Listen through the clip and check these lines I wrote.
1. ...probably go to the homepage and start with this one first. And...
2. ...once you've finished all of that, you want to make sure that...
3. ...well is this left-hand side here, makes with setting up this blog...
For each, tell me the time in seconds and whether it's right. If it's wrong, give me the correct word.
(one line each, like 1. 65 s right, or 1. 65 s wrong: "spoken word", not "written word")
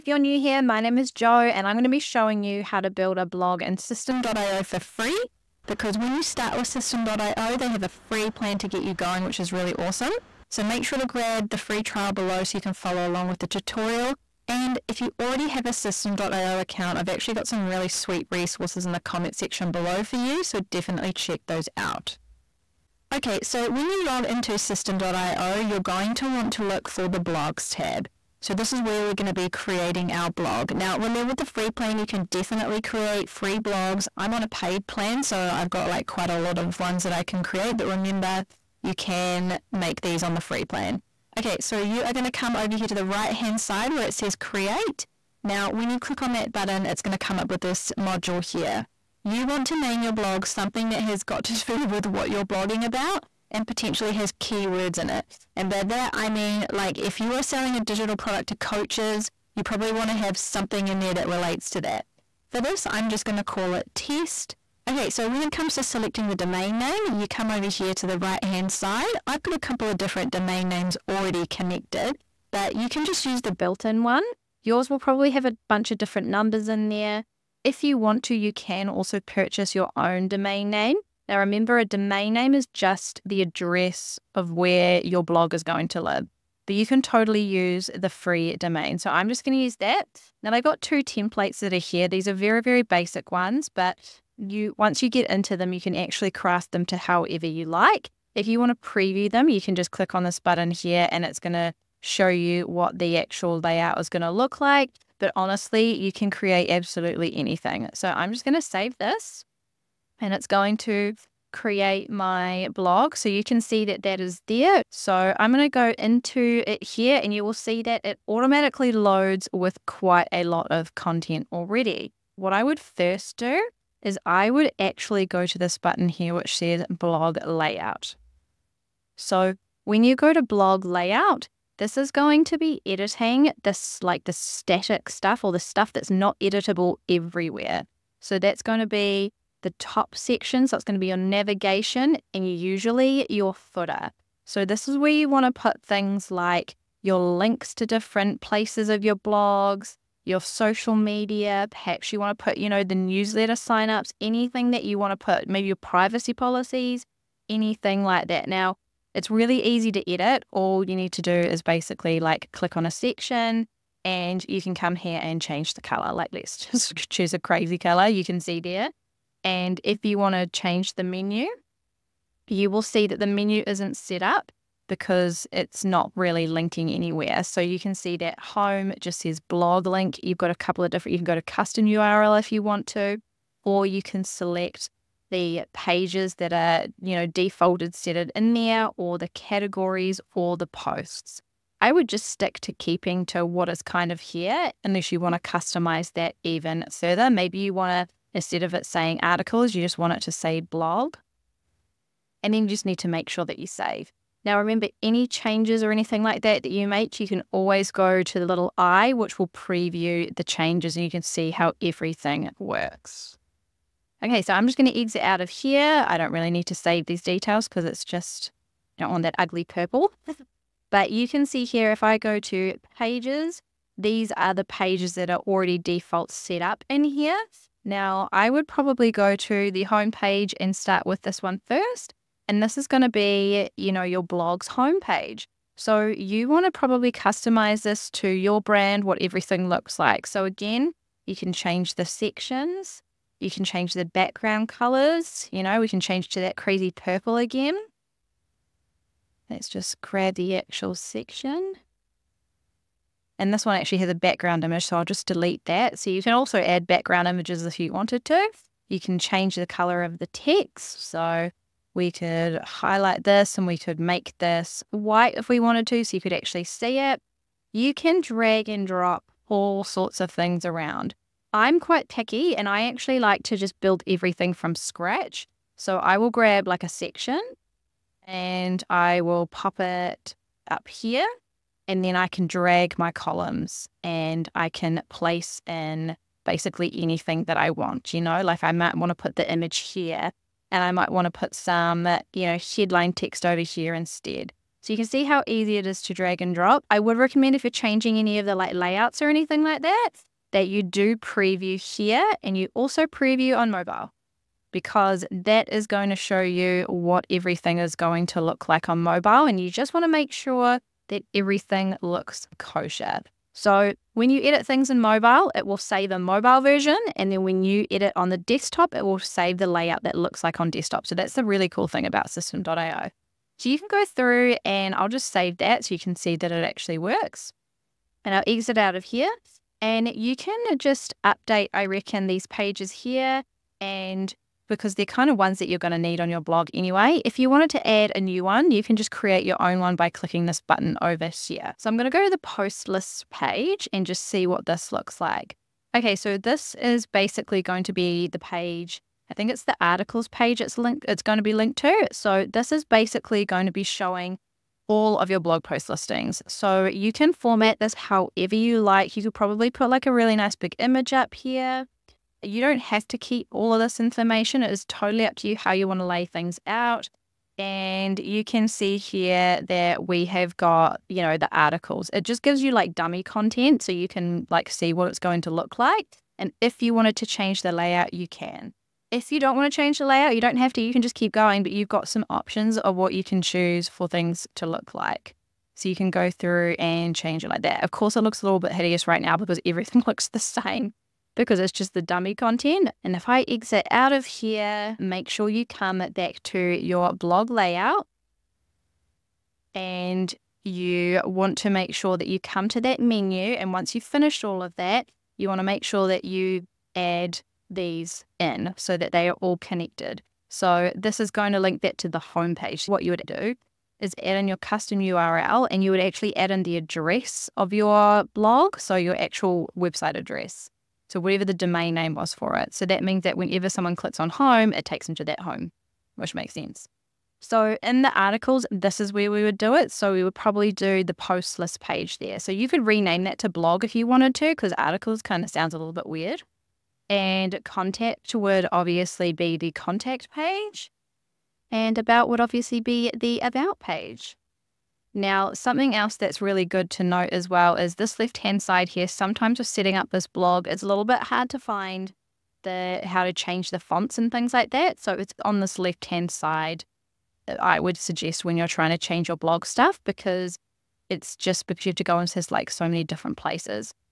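1. 228 s right
2. 403 s right
3. 447 s wrong: "sometimes", not "makes".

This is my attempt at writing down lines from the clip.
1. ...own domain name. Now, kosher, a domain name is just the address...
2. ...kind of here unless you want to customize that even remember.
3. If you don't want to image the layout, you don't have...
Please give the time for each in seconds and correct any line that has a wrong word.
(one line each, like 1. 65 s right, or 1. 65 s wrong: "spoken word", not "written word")
1. 79 s wrong: "remember", not "kosher"
2. 193 s wrong: "further", not "remember"
3. 379 s wrong: "change", not "image".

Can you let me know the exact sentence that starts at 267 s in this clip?
You can drag and drop all sorts of things around.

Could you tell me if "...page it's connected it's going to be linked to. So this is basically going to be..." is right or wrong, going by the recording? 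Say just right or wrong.
wrong.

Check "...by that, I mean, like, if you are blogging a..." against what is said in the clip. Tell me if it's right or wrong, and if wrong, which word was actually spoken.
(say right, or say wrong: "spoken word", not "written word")
wrong: "selling", not "blogging".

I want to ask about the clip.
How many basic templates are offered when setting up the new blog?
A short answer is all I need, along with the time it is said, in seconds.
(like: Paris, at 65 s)
2, at 90 s.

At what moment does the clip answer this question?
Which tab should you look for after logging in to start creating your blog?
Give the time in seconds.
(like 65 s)
27 s.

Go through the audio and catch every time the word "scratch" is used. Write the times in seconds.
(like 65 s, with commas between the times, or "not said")
274 s.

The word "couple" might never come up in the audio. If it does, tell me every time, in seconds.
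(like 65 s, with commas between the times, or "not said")
69 s, 180 s.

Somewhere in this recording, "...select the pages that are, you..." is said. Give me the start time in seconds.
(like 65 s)
184 s.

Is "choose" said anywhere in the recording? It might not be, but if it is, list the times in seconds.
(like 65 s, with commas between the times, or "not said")
167 s, 383 s.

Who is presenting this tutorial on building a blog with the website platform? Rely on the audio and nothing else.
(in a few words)
Jo.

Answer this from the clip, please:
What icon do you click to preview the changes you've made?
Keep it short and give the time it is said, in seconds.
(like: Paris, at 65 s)
The little eye, at 208 s.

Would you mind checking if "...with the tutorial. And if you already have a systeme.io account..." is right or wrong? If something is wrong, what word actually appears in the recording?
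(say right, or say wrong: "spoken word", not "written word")
right.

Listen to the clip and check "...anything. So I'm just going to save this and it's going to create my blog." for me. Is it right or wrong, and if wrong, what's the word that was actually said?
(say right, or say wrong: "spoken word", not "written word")
right.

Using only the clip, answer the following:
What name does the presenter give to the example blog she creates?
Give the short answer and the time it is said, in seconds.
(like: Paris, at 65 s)
test, at 63 s.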